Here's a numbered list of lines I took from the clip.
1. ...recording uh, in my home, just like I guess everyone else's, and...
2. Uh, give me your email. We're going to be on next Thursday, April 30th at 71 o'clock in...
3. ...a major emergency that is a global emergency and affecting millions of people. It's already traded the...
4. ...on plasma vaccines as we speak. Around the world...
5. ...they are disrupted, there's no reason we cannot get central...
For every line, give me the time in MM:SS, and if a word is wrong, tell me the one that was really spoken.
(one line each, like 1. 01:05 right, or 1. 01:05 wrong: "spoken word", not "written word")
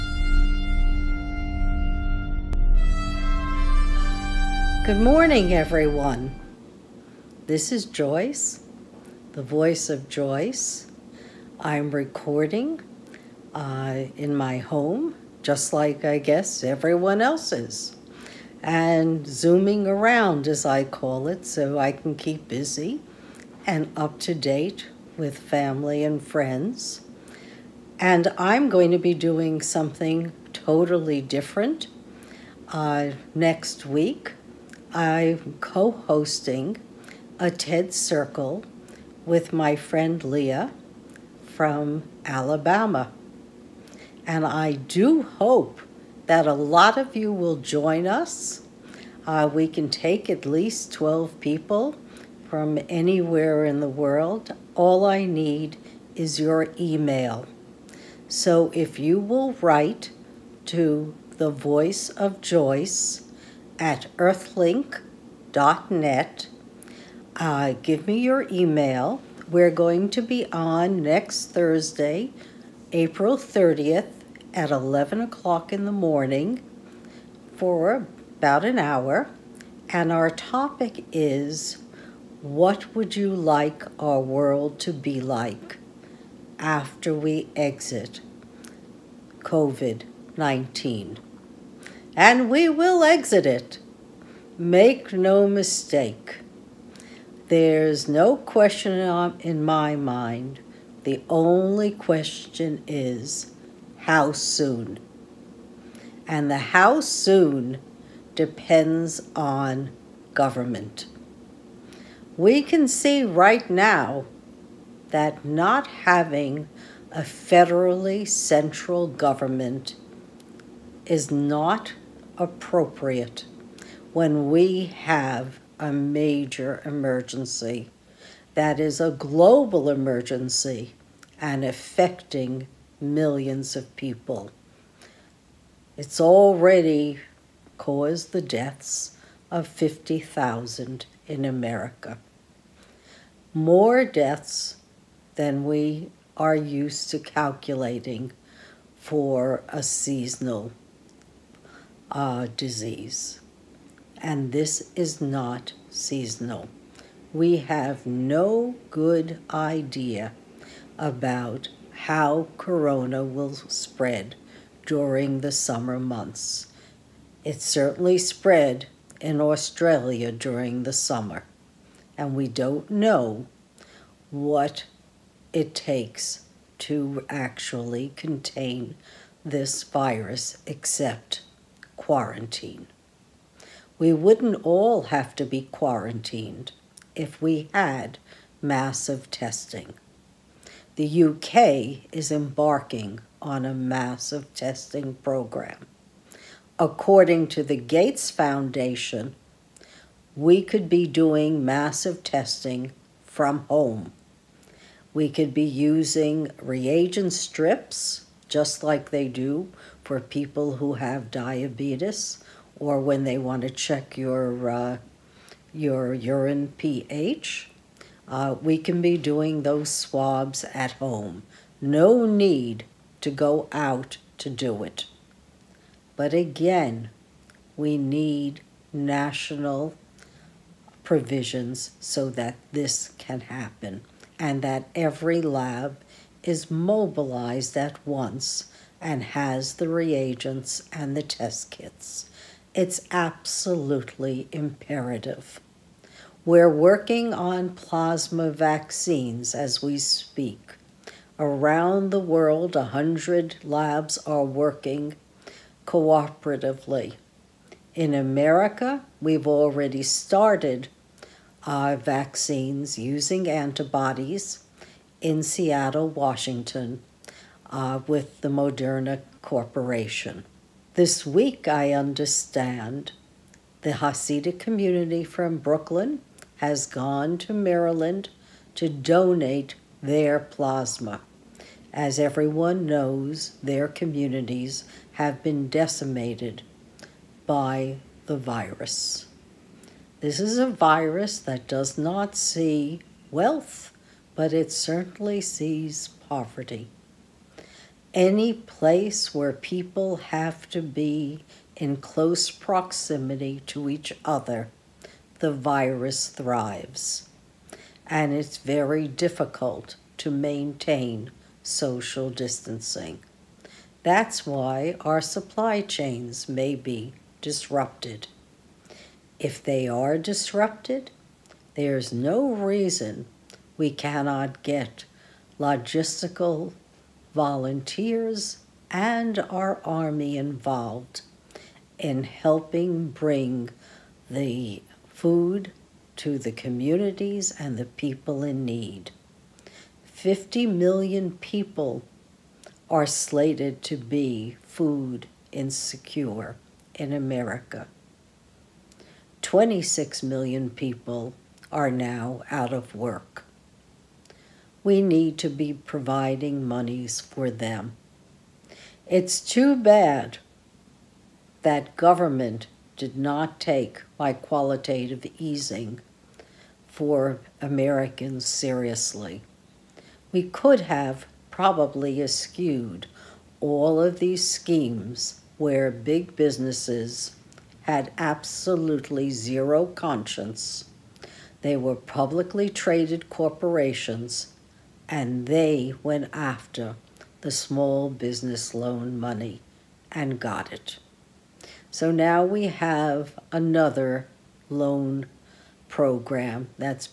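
1. 00:11 right
2. 01:07 wrong: "11", not "71"
3. 02:05 wrong: "caused", not "traded"
4. 04:07 right
5. 05:19 wrong: "logistical", not "central".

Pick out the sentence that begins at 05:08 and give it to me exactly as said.
And it's very difficult to maintain social distancing.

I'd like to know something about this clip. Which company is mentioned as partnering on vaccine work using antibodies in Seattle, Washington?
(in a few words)
Moderna.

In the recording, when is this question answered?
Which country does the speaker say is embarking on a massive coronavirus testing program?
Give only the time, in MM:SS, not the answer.
03:11.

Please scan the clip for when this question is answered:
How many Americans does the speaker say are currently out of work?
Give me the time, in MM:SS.
05:49.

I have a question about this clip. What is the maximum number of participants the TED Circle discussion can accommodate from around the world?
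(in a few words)
12.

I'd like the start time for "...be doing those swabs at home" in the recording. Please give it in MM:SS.
03:39.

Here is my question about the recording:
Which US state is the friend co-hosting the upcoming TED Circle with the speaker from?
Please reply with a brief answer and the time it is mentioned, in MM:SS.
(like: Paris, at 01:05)
Alabama, at 00:42.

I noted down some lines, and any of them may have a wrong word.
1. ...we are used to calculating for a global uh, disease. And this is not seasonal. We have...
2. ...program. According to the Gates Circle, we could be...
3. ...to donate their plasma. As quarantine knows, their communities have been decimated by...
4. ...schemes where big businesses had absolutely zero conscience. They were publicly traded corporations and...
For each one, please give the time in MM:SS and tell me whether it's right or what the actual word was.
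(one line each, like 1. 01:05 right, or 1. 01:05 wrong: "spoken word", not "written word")
1. 02:25 wrong: "seasonal", not "global"
2. 03:15 wrong: "Foundation", not "Circle"
3. 04:38 wrong: "everyone", not "quarantine"
4. 06:14 right.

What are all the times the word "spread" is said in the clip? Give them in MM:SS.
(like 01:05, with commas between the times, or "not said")
02:43, 02:48.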